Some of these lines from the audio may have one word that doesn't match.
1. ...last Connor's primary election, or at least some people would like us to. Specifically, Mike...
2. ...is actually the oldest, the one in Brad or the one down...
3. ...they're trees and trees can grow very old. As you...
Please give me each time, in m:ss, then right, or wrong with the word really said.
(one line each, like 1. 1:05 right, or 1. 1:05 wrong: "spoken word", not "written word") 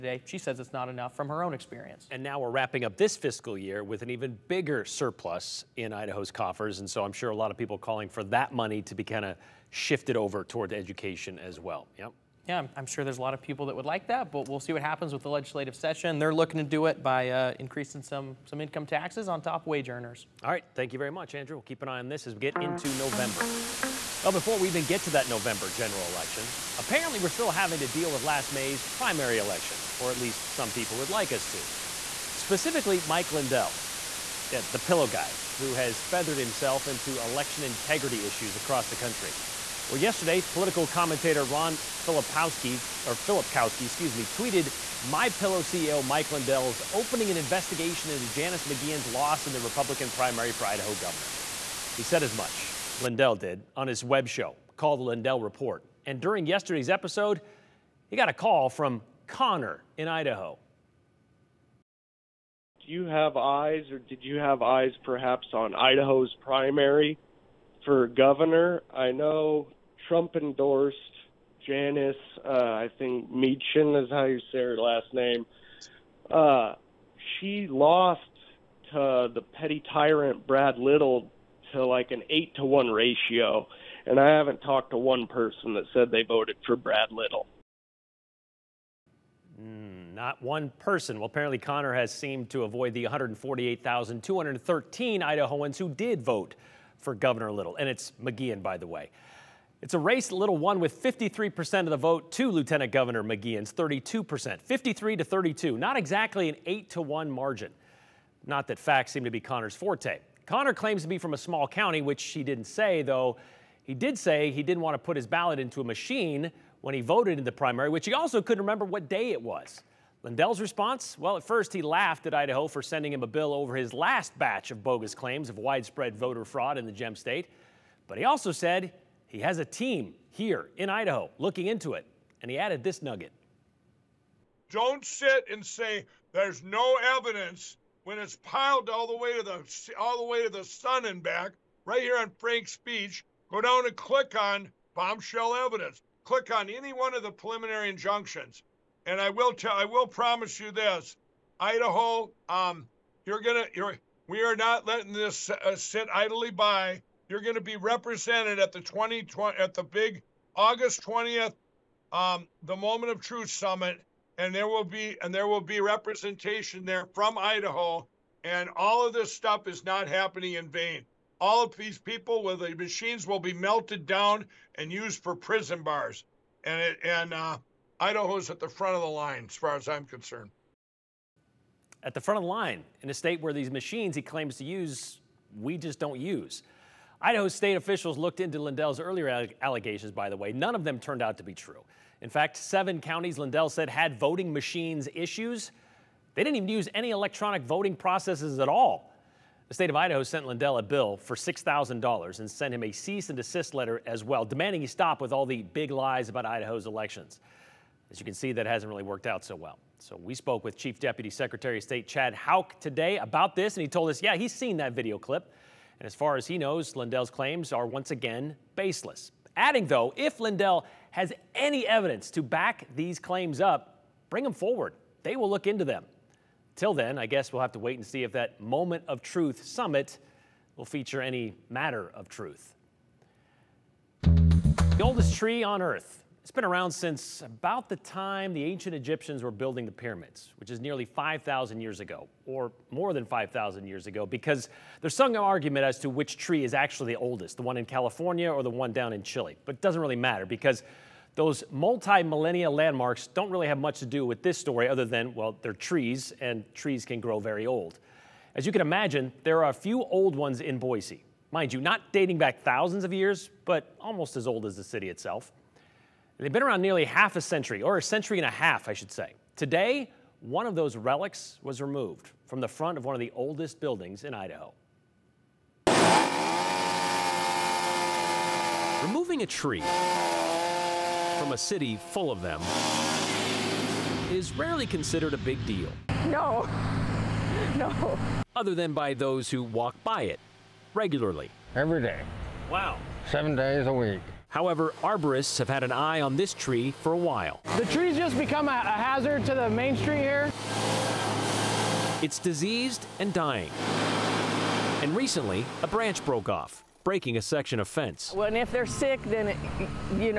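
1. 0:28 wrong: "May", not "Connor"
2. 4:06 wrong: "California", not "Brad"
3. 4:15 right.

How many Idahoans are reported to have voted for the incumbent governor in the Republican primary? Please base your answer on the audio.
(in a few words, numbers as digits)
148,213.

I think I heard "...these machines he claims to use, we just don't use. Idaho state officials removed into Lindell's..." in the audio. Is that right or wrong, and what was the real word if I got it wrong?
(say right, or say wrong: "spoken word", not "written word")
wrong: "looked", not "removed".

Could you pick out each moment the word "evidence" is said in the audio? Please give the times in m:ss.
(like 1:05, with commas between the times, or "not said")
2:17, 2:25, 3:41.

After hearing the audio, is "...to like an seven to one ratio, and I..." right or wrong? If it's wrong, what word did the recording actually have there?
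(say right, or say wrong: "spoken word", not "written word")
wrong: "eight", not "seven".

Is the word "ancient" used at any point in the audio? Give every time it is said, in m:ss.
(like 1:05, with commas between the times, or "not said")
3:58.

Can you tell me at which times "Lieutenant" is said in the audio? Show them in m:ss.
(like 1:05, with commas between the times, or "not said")
1:42.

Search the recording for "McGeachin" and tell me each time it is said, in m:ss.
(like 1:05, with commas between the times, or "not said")
0:48, 1:38, 1:43.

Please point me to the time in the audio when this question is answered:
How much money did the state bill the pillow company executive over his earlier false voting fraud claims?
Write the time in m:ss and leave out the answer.
3:21.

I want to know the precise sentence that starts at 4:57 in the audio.
The tree's just become a, a hazard to the main street here.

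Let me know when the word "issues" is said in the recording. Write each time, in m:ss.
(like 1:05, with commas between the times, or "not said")
0:38, 3:15.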